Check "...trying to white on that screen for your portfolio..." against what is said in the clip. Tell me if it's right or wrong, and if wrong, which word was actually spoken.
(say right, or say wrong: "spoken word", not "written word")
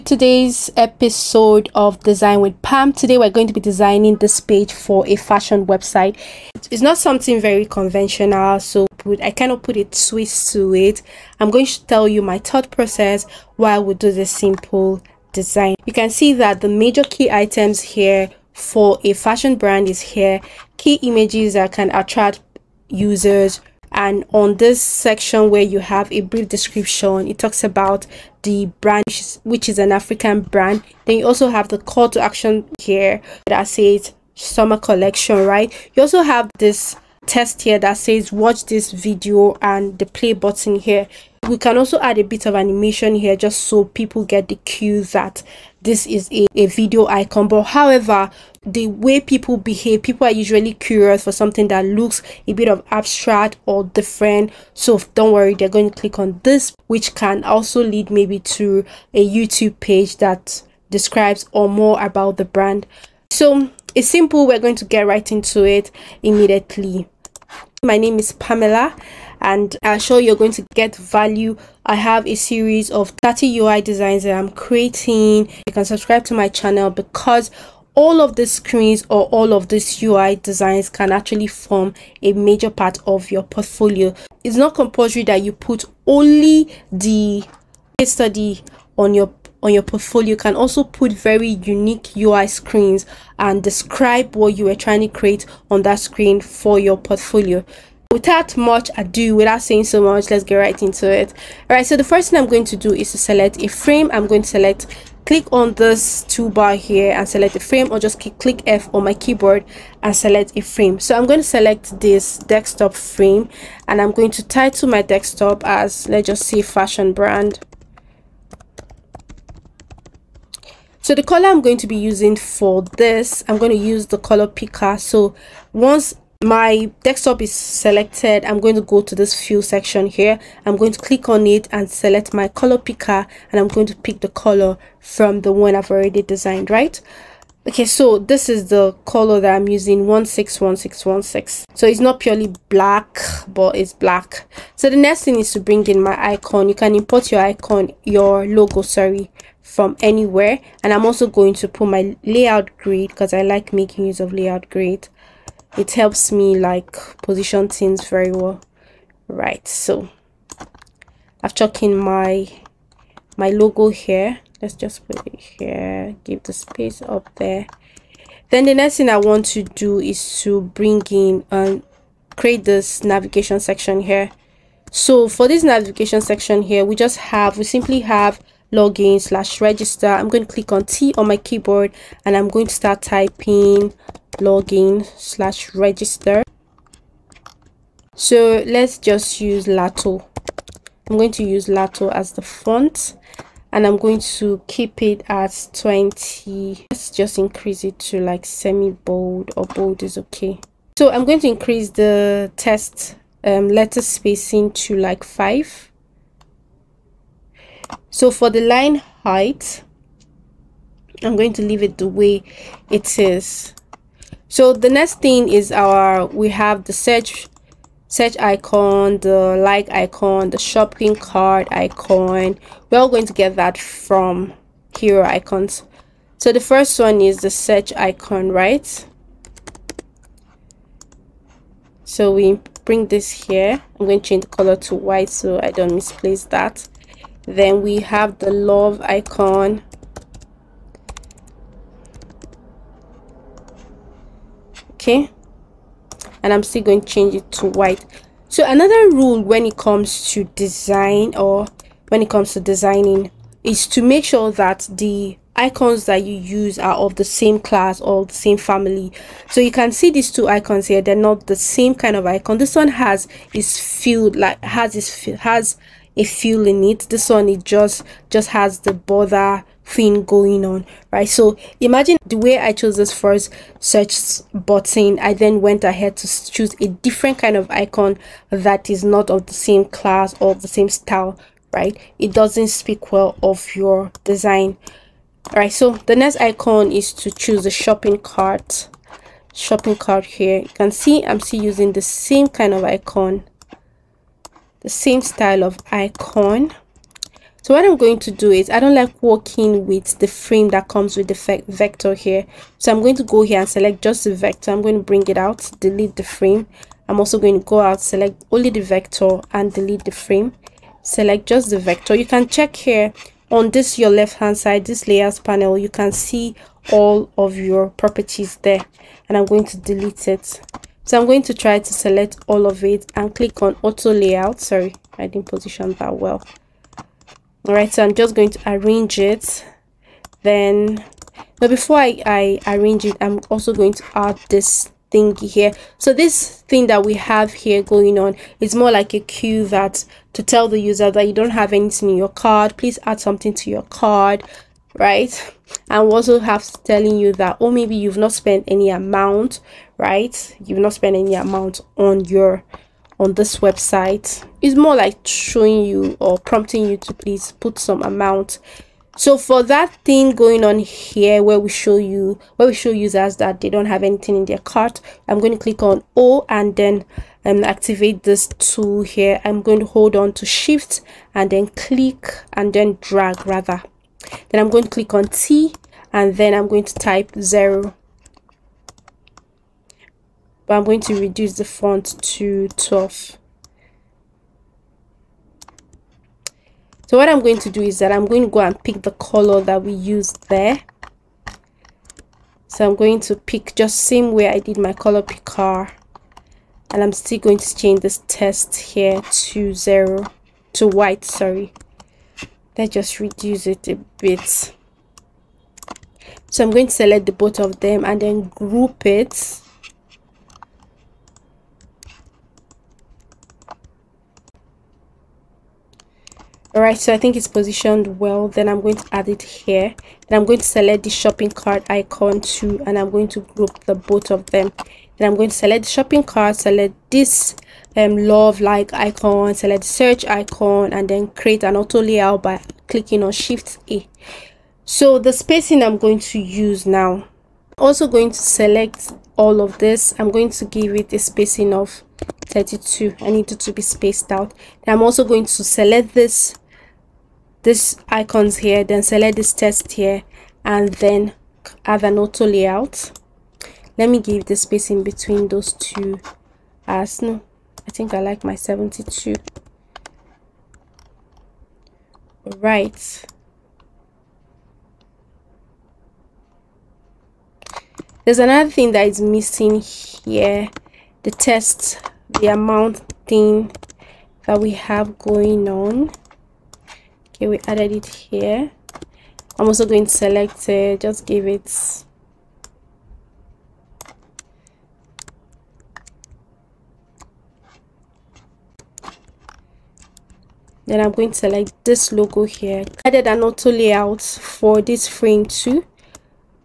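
wrong: "create", not "white".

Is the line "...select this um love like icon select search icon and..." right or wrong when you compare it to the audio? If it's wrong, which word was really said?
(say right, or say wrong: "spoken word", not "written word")
right.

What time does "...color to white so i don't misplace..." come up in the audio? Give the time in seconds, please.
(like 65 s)
234 s.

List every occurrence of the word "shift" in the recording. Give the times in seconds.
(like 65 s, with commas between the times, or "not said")
370 s, 433 s.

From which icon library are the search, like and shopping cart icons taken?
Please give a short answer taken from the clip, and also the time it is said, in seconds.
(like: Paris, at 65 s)
Hero Icons, at 224 s.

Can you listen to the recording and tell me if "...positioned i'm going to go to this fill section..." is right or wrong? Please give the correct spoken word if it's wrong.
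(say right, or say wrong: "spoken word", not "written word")
wrong: "selected", not "positioned".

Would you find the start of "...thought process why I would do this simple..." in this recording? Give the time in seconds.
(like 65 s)
12 s.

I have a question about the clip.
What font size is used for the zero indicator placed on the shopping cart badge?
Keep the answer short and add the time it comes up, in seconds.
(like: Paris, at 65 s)
12, at 382 s.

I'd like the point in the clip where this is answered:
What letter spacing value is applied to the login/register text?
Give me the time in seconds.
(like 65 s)
205 s.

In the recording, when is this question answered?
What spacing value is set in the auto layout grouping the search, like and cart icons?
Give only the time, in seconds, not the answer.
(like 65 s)
442 s.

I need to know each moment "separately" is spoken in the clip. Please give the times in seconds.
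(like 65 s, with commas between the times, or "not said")
not said.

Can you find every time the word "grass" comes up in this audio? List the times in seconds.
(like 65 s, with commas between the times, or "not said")
not said.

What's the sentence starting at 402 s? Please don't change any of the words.
Let's just reduce it a bit.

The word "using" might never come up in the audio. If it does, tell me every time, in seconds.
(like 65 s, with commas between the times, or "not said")
121 s, 139 s, 291 s.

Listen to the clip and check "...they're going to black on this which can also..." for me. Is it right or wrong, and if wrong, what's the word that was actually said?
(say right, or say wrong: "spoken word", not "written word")
wrong: "click", not "black".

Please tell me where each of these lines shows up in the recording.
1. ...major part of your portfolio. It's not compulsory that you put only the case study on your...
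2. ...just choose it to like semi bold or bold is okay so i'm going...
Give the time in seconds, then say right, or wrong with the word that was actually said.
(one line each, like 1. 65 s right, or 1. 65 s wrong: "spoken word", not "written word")
1. 82 s right
2. 197 s wrong: "increase", not "choose".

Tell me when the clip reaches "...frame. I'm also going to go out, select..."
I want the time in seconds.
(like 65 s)
306 s.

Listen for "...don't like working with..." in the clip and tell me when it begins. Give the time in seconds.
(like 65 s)
298 s.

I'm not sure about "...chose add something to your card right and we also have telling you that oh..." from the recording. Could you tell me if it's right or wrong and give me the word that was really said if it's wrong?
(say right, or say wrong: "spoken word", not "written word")
wrong: "please", not "chose".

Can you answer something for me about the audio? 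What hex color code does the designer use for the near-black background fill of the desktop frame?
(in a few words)
161616.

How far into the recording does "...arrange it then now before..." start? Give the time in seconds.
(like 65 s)
328 s.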